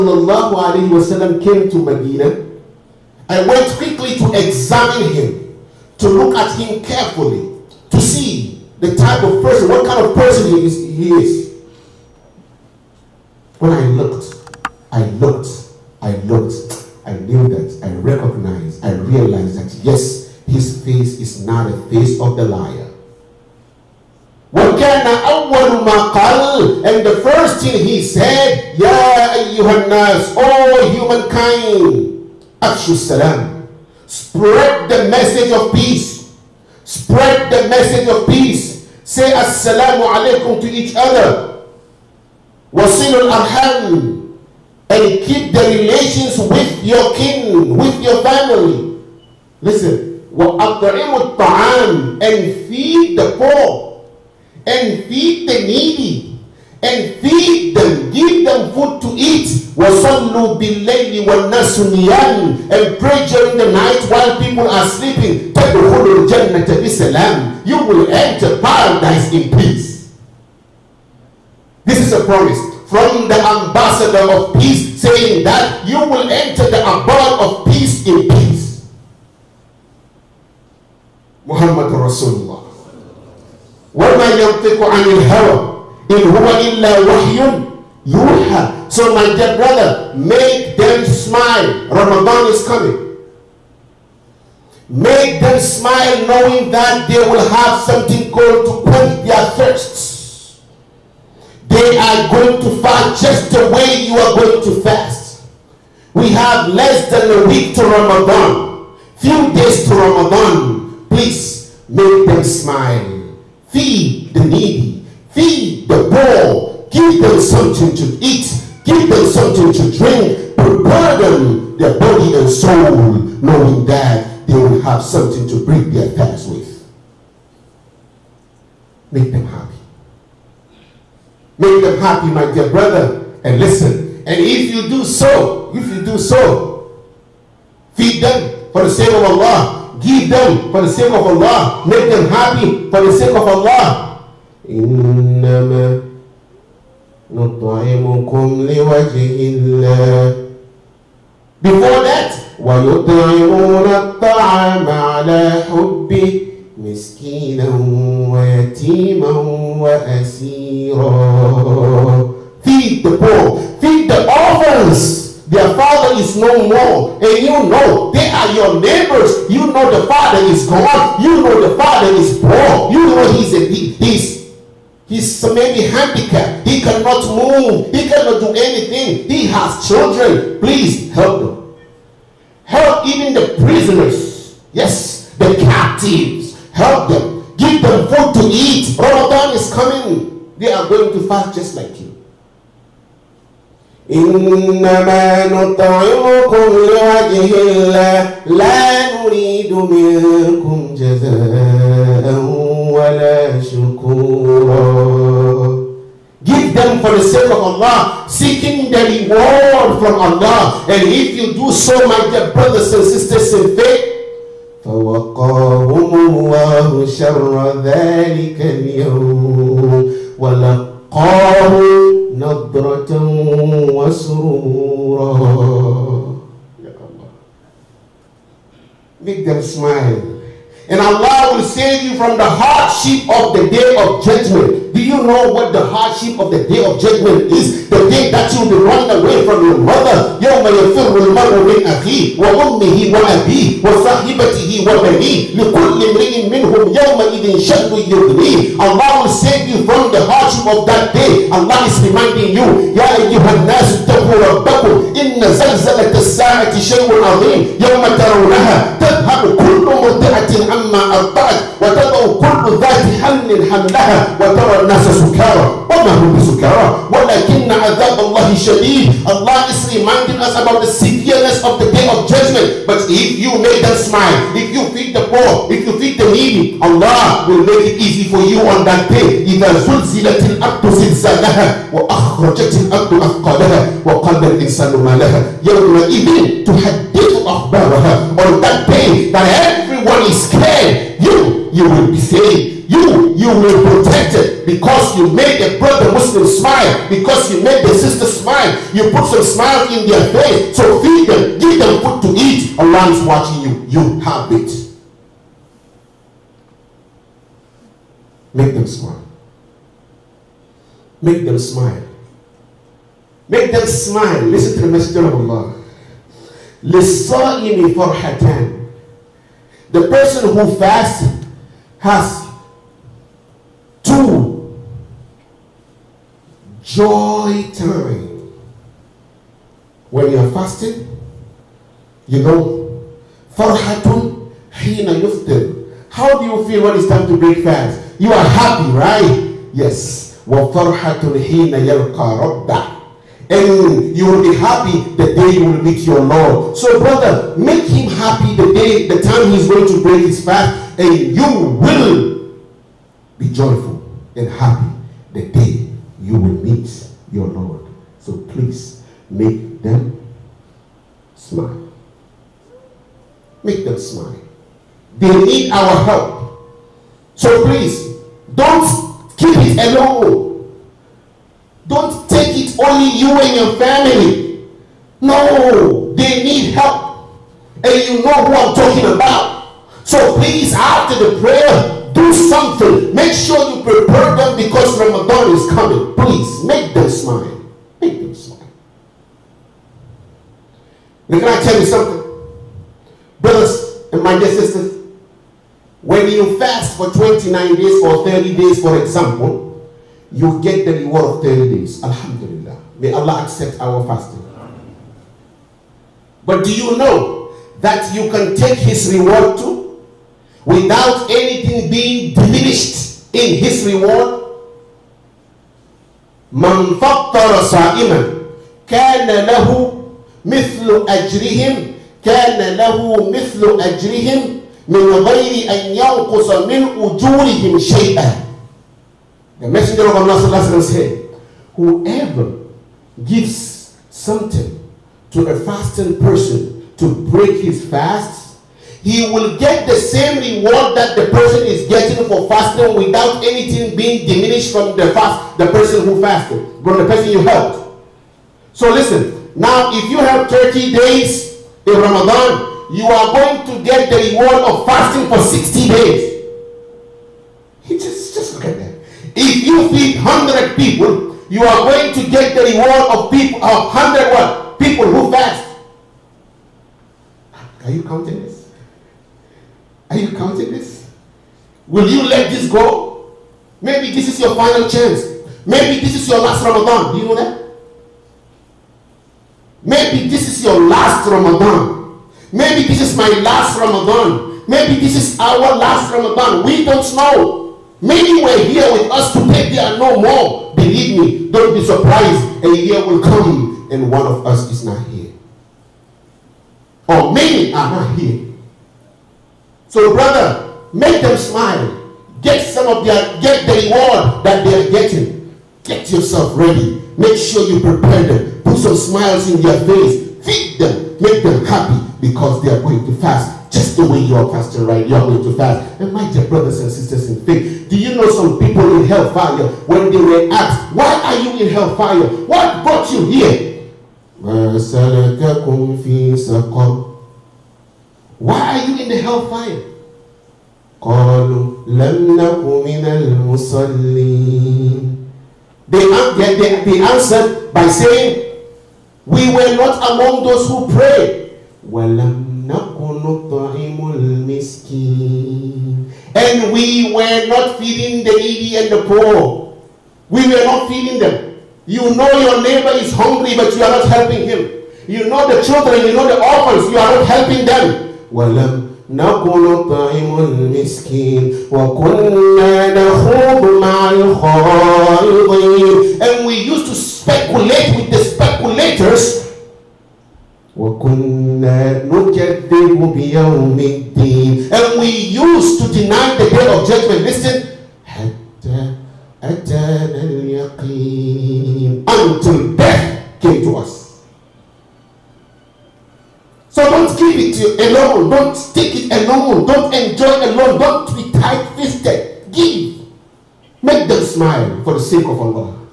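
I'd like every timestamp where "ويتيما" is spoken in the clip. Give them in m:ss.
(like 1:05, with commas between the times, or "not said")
2:38.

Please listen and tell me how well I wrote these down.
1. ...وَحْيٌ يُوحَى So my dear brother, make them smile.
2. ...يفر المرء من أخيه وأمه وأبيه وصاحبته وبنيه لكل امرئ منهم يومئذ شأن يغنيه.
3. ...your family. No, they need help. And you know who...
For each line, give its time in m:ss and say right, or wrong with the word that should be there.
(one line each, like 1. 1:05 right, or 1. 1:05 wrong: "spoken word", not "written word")
1. 1:27 right
2. 4:00 right
3. 6:13 right.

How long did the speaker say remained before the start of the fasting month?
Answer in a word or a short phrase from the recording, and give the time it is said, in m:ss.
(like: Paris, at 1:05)
Less than a week, at 1:46.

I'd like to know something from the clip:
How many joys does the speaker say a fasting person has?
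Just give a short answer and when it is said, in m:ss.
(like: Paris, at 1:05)
2, at 5:24.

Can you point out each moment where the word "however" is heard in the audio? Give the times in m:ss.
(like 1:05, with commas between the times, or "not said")
not said.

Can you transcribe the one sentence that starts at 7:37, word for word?
He just, just look at that.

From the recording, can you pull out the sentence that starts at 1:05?
تَدْخُلُوا الْجَنَّةَ بِسَلَامٍ you will enter paradise in peace.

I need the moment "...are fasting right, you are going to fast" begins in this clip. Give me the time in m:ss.
8:34.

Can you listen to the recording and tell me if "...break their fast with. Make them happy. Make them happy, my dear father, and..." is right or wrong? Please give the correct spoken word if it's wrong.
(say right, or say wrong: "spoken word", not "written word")
wrong: "brother", not "father".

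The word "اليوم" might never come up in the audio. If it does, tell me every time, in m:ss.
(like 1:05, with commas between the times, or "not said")
3:38.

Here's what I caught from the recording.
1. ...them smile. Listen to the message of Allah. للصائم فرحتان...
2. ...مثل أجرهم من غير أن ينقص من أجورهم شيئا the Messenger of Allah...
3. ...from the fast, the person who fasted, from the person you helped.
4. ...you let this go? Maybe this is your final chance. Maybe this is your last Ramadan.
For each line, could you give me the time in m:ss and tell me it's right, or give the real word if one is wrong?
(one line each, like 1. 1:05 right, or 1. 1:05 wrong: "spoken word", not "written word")
1. 5:13 right
2. 7:03 right
3. 7:24 right
4. 7:52 right.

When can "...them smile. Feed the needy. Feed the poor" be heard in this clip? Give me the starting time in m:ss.
1:52.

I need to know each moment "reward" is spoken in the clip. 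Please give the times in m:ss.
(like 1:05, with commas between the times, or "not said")
3:29, 6:41, 6:49, 6:53, 7:20, 7:34, 7:42, 8:23.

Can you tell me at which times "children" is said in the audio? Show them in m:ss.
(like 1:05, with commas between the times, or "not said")
2:59, 9:15.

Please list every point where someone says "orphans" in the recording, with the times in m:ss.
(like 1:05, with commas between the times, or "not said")
2:44, 9:16.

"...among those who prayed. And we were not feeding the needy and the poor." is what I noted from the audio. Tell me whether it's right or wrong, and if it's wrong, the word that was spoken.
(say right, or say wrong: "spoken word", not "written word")
right.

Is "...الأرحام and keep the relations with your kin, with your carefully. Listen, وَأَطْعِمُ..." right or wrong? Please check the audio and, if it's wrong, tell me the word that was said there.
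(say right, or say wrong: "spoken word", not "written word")
wrong: "family", not "carefully".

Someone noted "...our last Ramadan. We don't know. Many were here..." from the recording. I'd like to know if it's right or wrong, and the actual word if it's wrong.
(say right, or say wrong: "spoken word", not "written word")
right.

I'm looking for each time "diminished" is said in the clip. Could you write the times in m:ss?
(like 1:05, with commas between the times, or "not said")
6:52, 7:24.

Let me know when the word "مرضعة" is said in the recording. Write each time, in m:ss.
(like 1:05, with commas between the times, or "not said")
4:19.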